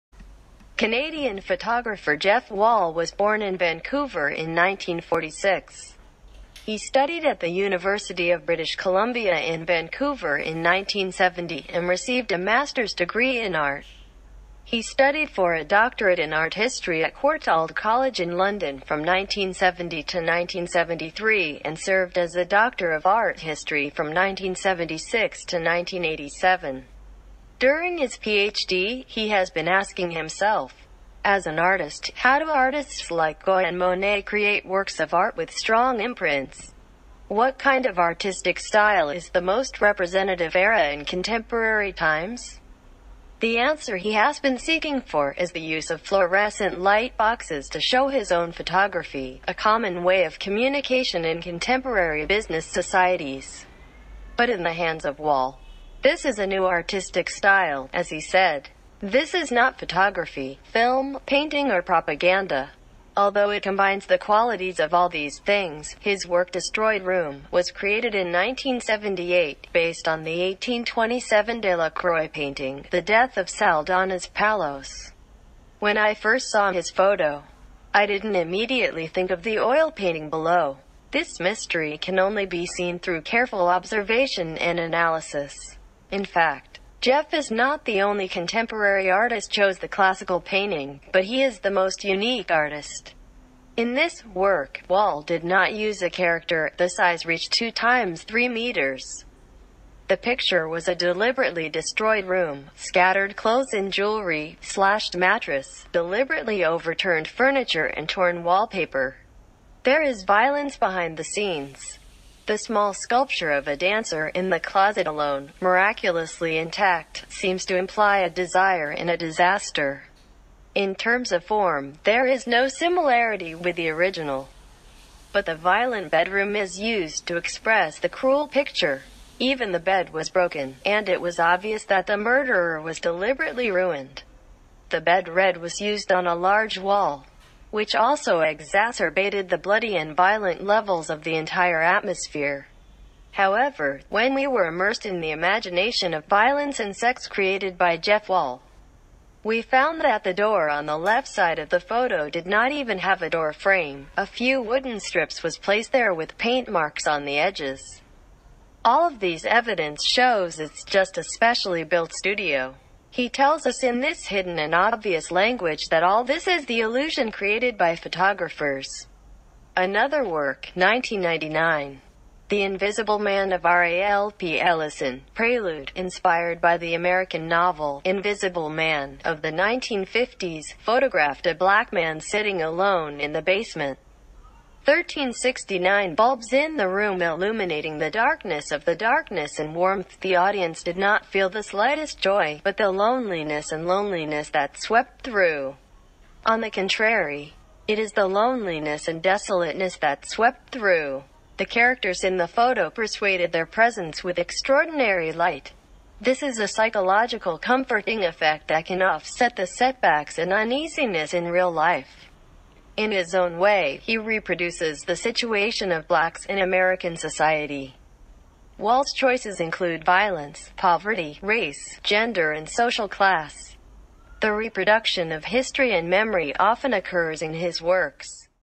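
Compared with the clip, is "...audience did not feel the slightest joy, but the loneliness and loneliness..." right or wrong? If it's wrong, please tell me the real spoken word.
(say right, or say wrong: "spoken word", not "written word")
right.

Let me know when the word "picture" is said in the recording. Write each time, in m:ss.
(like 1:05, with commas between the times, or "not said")
1:40, 2:08.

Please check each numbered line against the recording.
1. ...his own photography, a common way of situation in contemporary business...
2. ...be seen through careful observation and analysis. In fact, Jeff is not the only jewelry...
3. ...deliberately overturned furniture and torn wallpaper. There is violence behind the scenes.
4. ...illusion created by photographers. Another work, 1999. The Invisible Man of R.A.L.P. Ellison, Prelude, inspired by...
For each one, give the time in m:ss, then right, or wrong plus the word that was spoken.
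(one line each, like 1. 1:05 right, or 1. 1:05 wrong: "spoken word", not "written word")
1. 0:48 wrong: "communication", not "situation"
2. 1:22 wrong: "contemporary", not "jewelry"
3. 1:45 right
4. 2:46 right.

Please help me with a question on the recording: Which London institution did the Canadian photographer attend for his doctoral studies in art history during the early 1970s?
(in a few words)
Courtauld College.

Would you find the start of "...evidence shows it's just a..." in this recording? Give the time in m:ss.
2:39.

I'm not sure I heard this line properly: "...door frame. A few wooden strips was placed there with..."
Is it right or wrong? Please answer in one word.
right.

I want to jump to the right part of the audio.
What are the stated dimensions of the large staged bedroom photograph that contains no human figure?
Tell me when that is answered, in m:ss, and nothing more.
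1:37.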